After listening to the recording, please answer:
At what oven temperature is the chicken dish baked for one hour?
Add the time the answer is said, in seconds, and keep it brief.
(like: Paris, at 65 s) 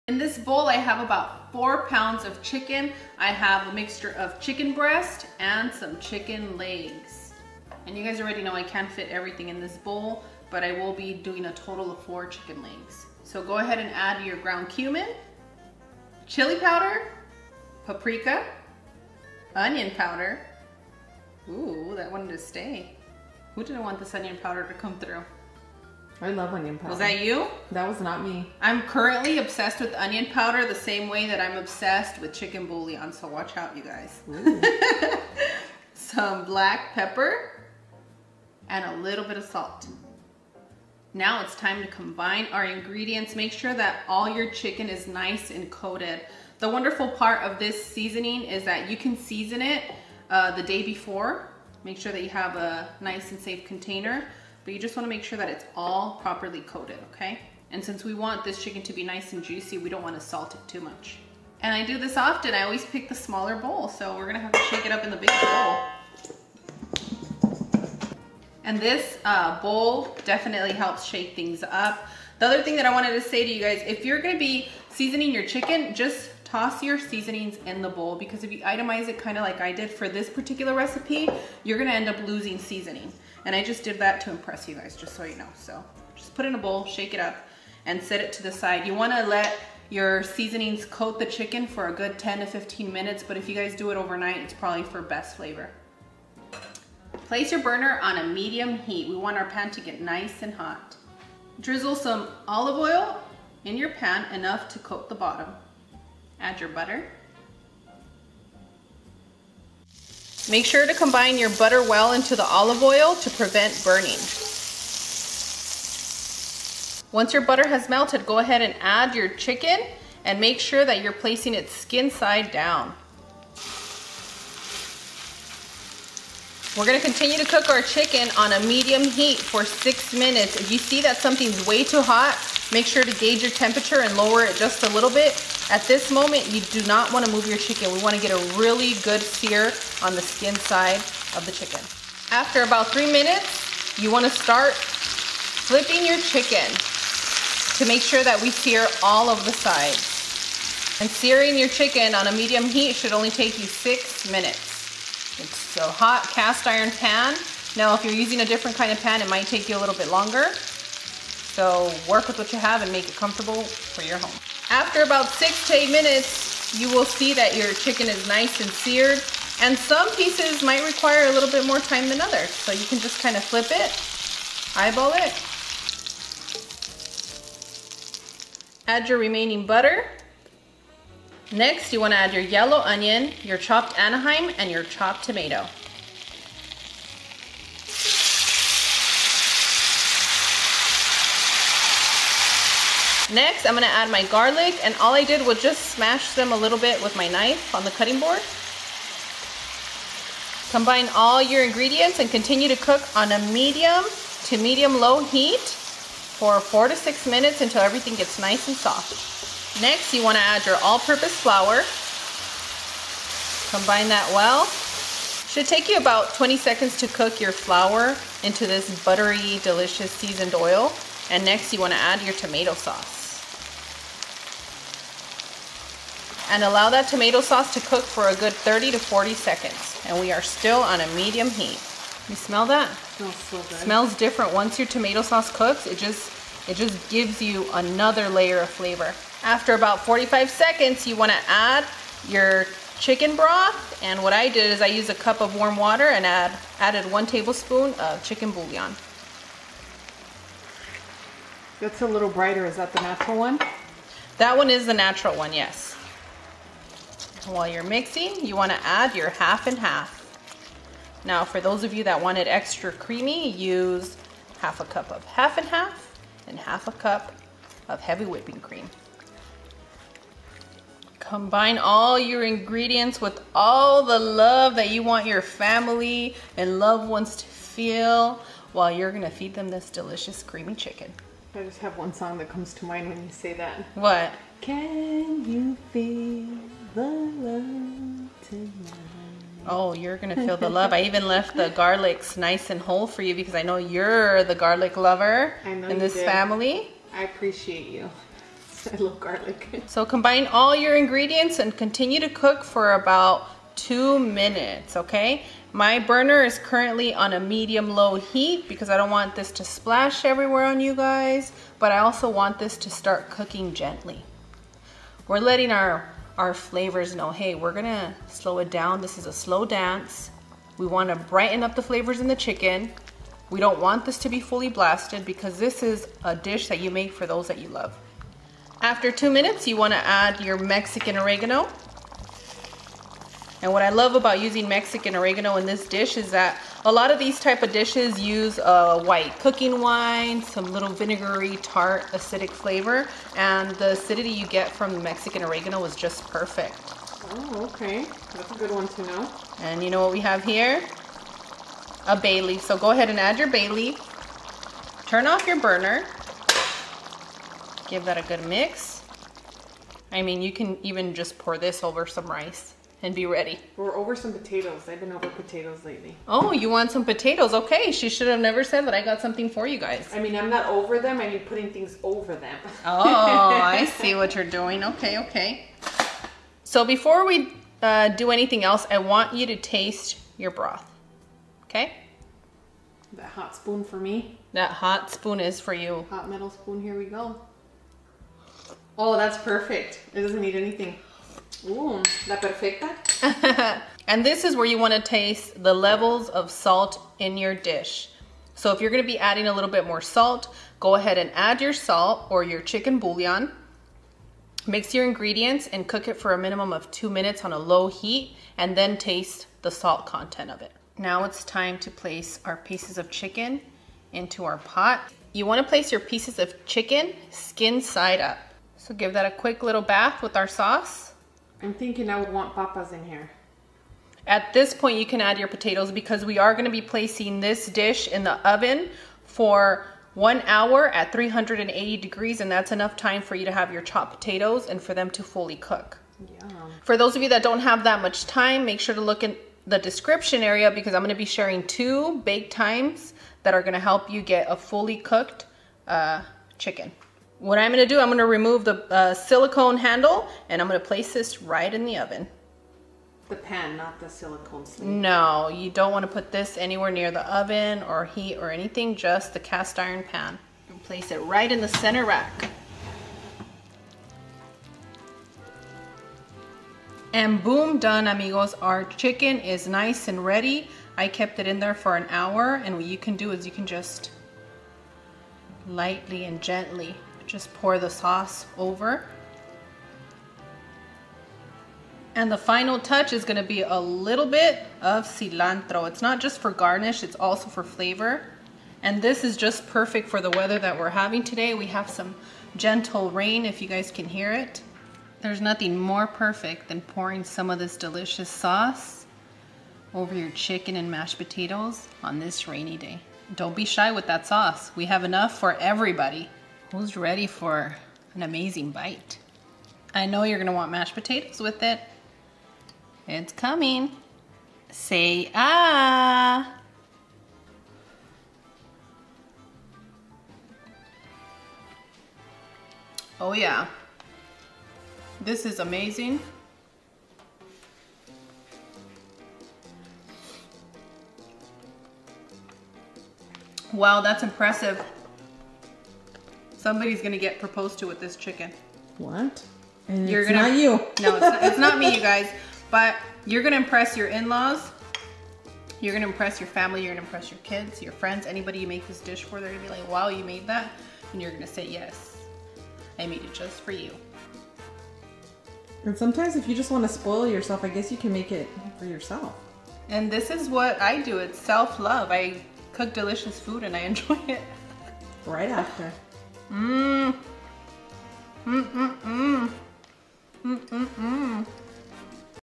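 380 degrees, at 431 s.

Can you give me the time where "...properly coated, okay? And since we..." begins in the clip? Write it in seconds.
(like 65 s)
56 s.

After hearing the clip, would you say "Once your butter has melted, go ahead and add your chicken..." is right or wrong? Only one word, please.
right.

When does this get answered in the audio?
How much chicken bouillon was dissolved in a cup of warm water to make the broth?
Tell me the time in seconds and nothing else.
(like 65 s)
247 s.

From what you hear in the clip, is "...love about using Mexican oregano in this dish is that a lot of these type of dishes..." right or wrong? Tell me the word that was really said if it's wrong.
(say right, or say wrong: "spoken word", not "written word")
right.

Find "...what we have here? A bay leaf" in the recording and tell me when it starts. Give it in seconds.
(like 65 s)
350 s.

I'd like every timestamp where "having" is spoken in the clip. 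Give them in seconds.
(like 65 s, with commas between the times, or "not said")
490 s.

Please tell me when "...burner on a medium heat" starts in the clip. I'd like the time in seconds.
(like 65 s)
97 s.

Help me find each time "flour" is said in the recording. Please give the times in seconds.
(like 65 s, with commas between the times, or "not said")
211 s, 217 s.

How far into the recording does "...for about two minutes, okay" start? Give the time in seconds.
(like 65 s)
302 s.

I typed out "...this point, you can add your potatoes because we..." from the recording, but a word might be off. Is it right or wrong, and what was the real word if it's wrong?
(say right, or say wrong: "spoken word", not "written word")
right.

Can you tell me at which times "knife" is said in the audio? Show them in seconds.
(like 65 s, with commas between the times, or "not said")
197 s.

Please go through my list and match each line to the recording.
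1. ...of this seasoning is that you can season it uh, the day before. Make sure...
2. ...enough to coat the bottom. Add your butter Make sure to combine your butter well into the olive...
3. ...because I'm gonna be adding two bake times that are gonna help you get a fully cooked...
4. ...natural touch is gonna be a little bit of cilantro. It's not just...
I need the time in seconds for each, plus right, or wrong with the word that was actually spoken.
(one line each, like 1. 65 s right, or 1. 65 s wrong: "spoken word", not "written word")
1. 47 s right
2. 104 s right
3. 440 s wrong: "sharing", not "adding"
4. 482 s wrong: "final", not "natural".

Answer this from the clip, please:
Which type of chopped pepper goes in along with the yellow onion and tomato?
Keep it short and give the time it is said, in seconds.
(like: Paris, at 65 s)
Anaheim, at 183 s.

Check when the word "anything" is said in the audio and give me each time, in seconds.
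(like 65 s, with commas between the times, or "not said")
378 s, 390 s, 458 s.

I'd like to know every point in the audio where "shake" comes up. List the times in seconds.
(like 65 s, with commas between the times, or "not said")
64 s, 71 s, 86 s.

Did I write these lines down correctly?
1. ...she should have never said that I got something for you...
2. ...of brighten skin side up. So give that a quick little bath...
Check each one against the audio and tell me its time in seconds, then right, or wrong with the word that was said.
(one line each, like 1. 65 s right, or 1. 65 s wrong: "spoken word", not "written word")
1. 367 s right
2. 416 s wrong: "chicken", not "brighten".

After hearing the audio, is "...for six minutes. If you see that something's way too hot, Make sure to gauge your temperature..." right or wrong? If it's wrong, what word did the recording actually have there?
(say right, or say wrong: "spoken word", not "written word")
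right.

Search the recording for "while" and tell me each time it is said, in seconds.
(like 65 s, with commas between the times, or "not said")
257 s, 278 s.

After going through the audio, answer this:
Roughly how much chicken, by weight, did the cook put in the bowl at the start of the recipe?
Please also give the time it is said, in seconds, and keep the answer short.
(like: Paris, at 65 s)
4 pounds, at 1 s.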